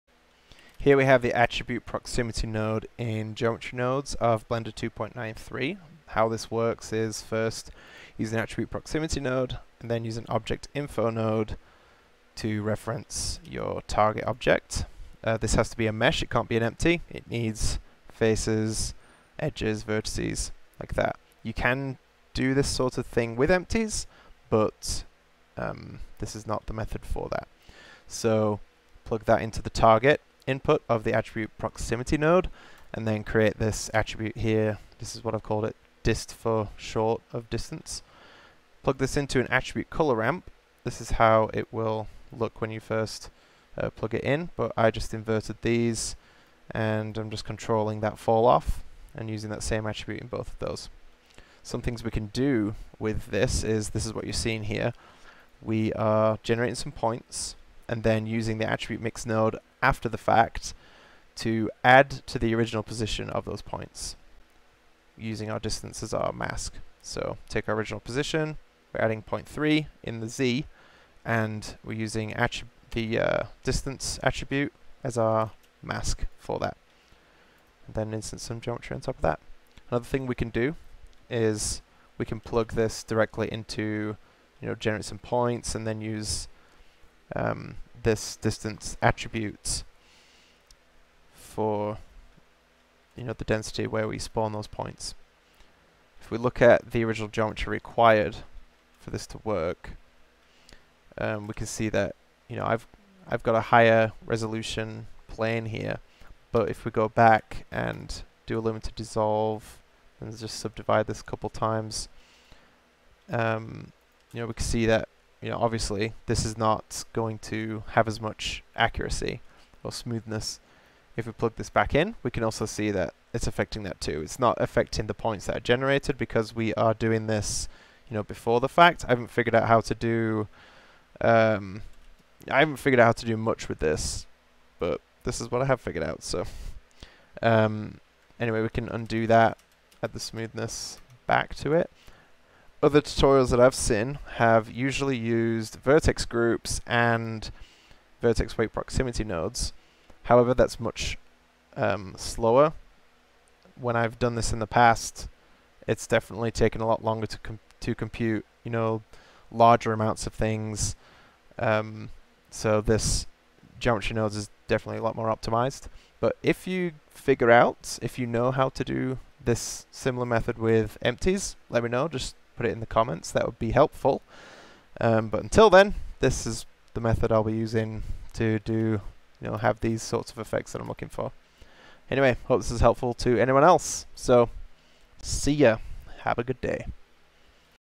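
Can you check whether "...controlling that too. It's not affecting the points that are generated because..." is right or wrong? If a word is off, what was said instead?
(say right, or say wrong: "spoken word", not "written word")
wrong: "affecting", not "controlling".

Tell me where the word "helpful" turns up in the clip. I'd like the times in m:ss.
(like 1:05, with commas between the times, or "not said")
2:53, 3:02.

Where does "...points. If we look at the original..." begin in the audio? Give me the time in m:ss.
1:34.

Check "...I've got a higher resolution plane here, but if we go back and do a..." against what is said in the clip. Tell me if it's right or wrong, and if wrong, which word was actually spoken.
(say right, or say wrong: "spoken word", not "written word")
right.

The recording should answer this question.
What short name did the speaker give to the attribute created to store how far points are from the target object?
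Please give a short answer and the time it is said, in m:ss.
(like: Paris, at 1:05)
dist, at 0:36.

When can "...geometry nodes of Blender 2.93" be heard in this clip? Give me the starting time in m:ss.
0:03.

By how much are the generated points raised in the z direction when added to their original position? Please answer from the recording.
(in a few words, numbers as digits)
0.3.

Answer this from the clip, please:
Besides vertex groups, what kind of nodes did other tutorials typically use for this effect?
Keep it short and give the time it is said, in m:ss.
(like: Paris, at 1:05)
vertex weight proximity, at 2:28.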